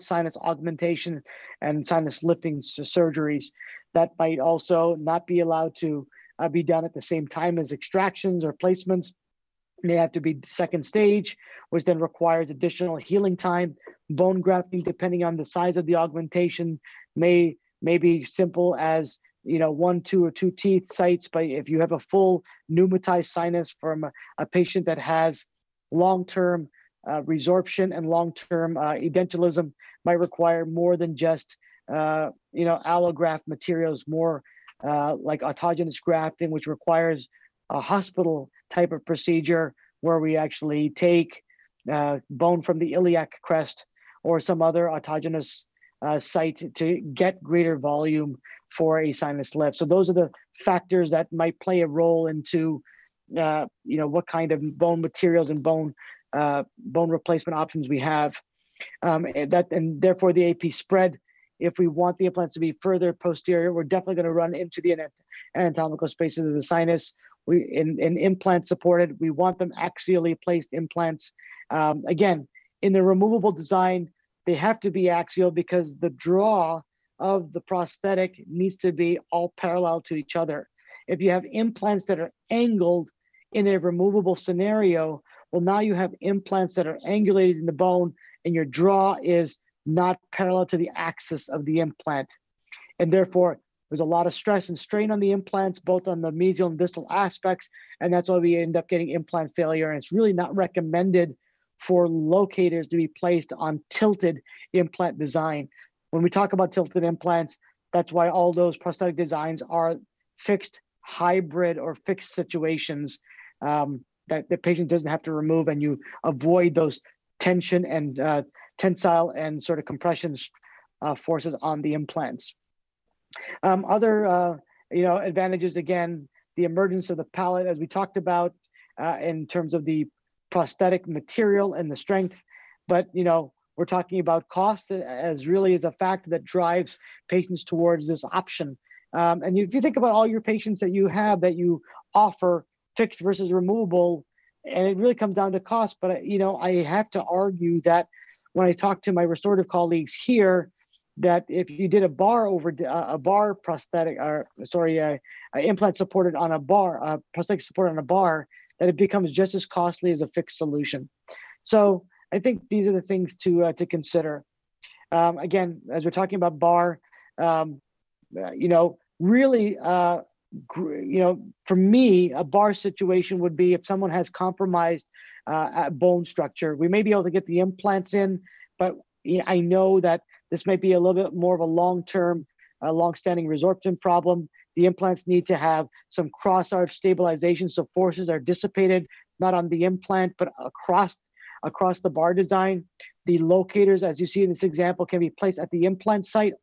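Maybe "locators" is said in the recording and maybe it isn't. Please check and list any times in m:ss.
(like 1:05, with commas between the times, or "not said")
1:42, 3:13.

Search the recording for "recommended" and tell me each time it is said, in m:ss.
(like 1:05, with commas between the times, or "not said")
1:40.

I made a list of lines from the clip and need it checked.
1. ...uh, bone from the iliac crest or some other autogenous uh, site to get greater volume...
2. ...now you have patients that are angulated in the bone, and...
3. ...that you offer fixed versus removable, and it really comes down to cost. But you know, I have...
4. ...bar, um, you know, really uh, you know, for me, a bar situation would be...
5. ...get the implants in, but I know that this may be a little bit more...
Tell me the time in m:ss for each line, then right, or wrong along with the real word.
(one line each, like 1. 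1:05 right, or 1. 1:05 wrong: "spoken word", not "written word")
1. 0:41 right
2. 1:25 wrong: "implants", not "patients"
3. 2:21 right
4. 2:46 right
5. 2:57 right.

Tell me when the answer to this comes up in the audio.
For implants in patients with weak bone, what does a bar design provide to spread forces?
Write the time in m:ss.
3:06.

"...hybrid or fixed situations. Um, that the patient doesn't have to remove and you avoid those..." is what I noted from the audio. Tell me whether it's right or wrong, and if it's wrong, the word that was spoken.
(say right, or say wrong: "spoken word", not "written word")
right.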